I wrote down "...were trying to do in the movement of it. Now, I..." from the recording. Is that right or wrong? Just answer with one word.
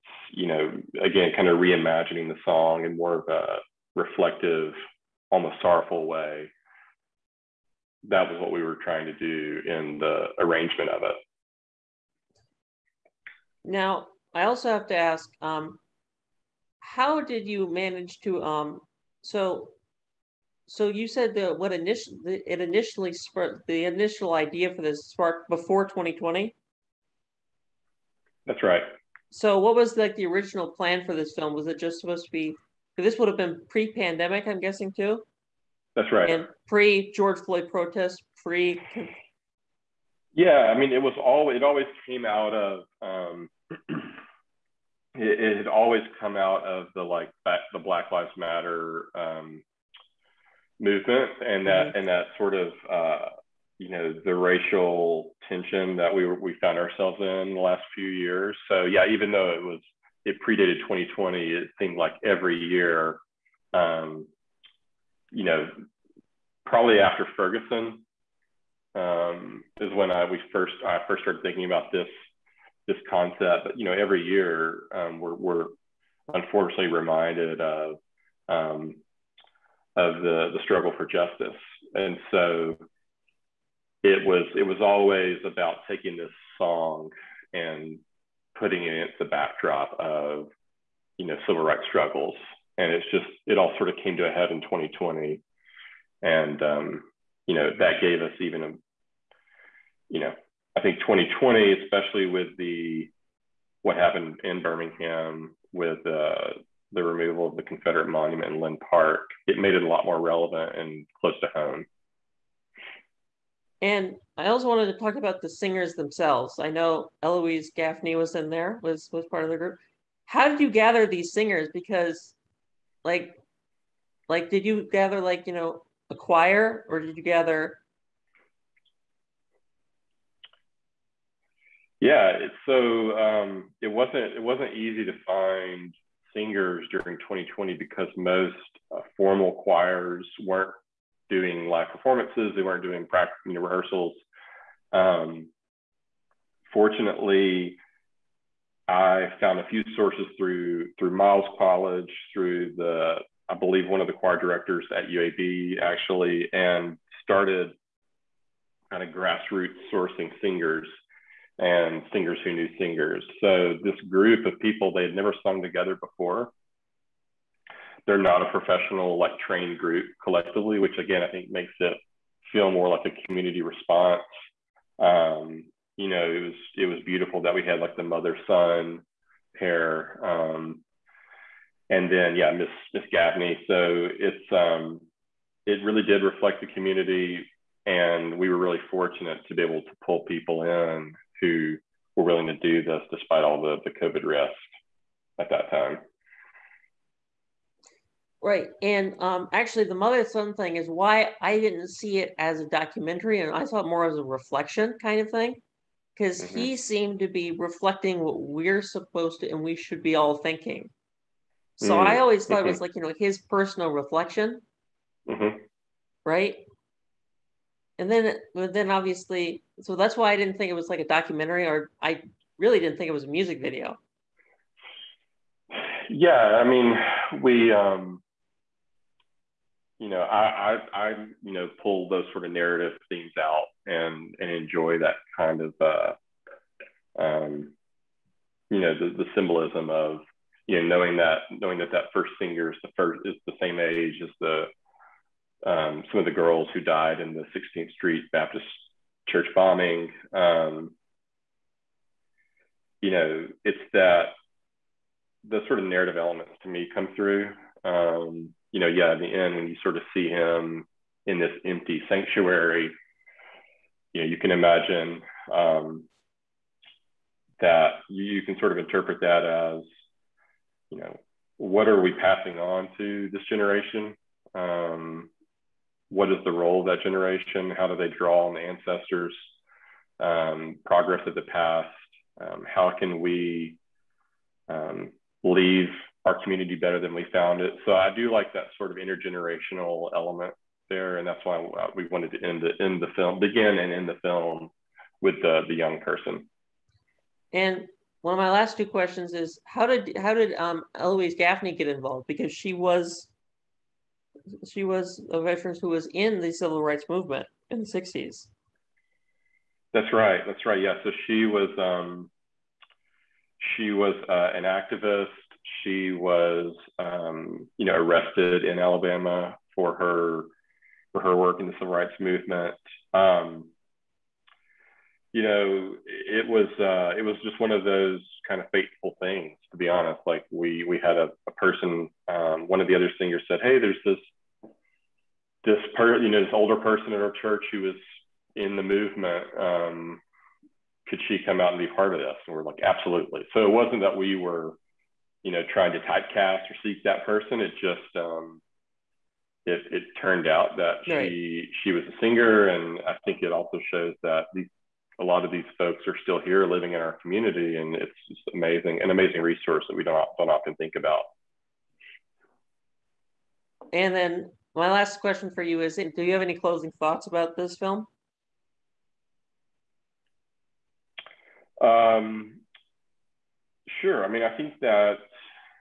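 wrong.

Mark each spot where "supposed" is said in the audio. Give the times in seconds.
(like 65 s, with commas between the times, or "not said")
32 s, 208 s.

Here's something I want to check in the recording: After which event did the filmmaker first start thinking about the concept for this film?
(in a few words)
Ferguson.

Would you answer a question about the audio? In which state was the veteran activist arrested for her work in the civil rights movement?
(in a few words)
Alabama.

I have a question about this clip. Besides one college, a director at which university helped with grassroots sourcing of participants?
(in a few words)
UAB.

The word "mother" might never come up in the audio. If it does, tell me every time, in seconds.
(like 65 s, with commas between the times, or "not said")
178 s, 199 s.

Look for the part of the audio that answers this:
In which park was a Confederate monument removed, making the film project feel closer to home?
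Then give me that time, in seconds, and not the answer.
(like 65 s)
108 s.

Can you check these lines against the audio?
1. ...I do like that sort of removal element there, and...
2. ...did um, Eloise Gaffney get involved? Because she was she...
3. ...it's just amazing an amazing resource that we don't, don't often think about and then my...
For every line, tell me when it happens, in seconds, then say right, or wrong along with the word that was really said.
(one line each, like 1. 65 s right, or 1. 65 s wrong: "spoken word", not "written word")
1. 287 s wrong: "intergenerational", not "removal"
2. 300 s right
3. 357 s right.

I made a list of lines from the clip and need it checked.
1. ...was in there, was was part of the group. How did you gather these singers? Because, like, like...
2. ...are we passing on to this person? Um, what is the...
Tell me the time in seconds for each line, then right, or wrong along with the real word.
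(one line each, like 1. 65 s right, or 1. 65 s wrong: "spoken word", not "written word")
1. 118 s right
2. 271 s wrong: "generation", not "person".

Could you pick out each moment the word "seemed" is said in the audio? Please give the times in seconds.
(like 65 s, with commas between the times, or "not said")
61 s, 206 s.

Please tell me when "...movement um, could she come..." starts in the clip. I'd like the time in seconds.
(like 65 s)
338 s.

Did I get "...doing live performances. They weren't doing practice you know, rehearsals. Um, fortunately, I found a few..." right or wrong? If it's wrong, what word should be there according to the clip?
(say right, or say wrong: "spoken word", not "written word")
right.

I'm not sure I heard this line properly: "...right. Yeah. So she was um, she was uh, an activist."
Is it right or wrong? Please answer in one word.
right.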